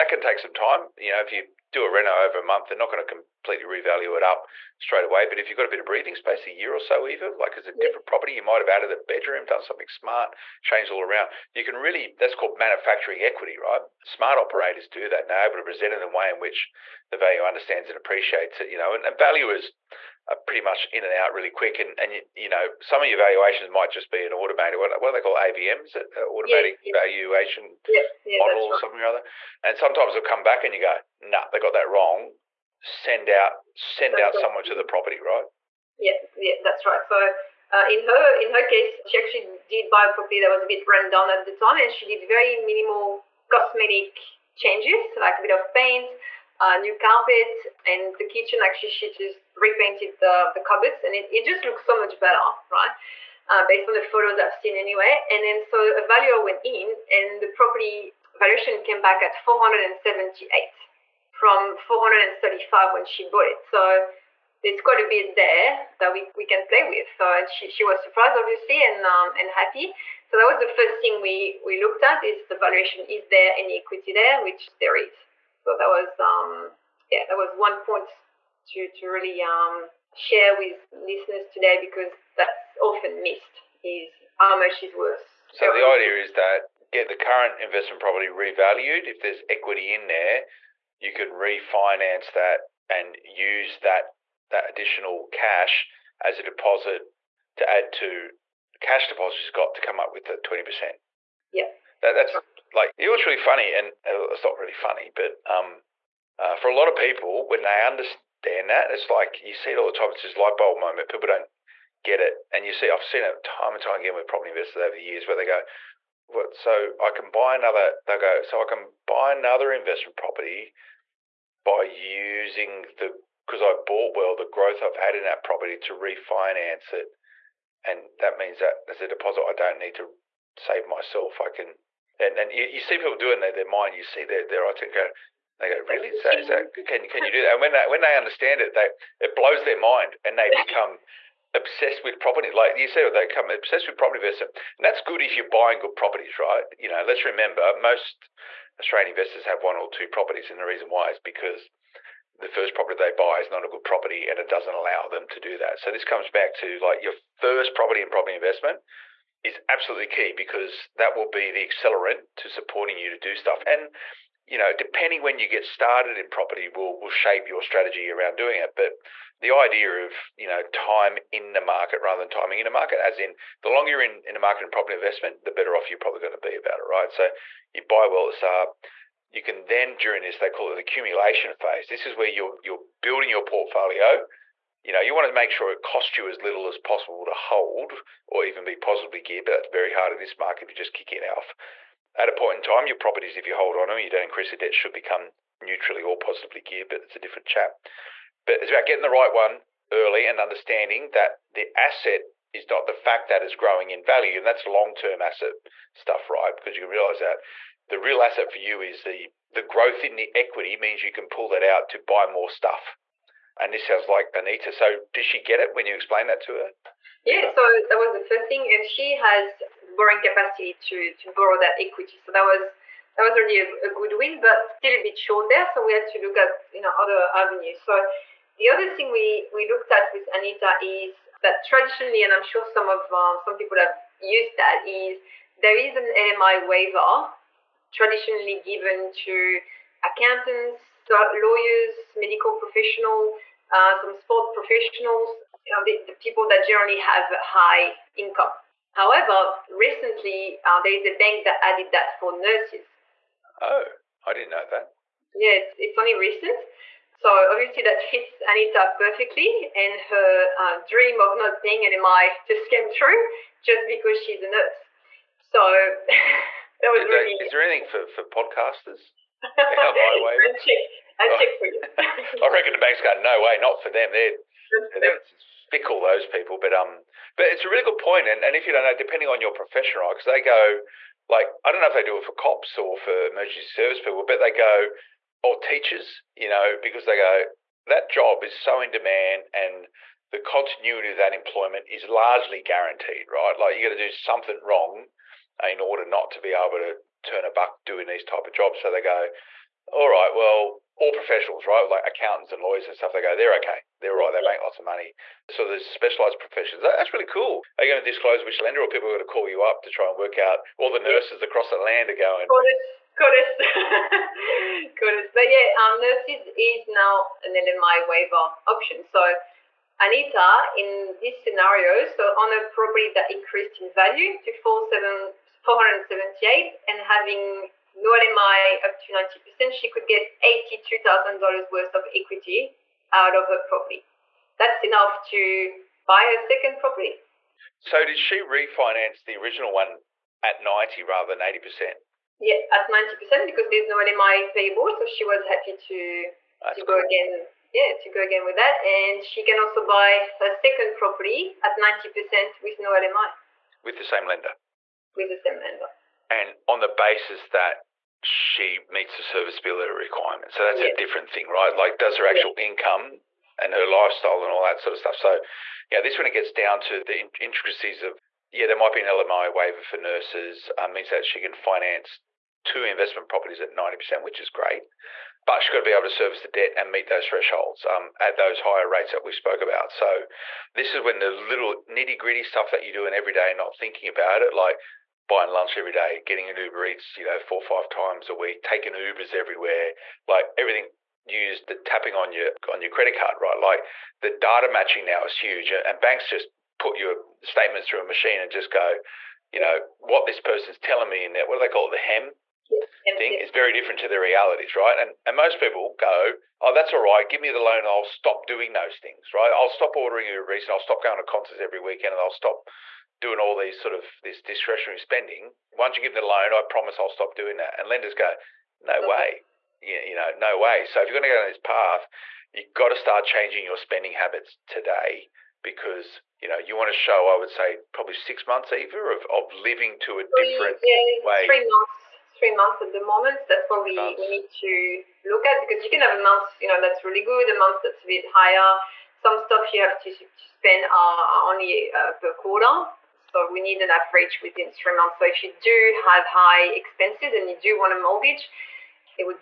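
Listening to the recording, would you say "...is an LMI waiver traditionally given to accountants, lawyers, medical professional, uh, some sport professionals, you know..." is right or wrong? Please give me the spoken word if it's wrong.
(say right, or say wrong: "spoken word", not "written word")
right.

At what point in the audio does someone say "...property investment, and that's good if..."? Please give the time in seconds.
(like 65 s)
143 s.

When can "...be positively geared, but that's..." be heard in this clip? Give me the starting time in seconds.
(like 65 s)
188 s.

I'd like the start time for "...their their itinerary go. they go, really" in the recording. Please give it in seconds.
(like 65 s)
134 s.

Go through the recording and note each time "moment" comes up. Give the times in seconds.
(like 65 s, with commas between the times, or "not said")
110 s, 432 s.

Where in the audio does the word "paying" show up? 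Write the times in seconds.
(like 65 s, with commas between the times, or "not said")
261 s.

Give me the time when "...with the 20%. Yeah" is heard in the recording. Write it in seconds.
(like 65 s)
100 s.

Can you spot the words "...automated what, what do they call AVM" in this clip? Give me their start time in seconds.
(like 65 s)
24 s.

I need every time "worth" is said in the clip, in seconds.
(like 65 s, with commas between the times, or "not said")
84 s, 331 s.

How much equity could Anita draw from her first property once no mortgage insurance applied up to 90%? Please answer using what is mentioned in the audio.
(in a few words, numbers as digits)
$82,000.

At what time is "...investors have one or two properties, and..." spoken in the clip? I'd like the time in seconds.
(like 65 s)
149 s.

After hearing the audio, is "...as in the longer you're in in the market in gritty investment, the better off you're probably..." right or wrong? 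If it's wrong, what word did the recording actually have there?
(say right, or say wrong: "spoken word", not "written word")
wrong: "property", not "gritty".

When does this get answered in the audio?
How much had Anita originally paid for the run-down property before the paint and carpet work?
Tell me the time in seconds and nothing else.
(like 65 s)
61 s.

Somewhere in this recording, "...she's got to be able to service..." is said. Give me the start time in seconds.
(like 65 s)
375 s.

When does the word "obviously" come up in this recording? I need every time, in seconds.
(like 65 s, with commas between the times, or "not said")
68 s, 257 s.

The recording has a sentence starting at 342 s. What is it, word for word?
Yeah, at 90% because there's no LMI payable.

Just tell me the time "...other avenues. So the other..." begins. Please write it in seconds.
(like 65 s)
226 s.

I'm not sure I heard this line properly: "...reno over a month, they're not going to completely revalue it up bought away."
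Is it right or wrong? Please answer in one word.
wrong.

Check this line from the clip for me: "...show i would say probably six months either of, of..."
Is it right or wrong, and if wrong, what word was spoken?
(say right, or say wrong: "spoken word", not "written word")
right.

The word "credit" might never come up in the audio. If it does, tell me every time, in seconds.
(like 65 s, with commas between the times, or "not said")
392 s.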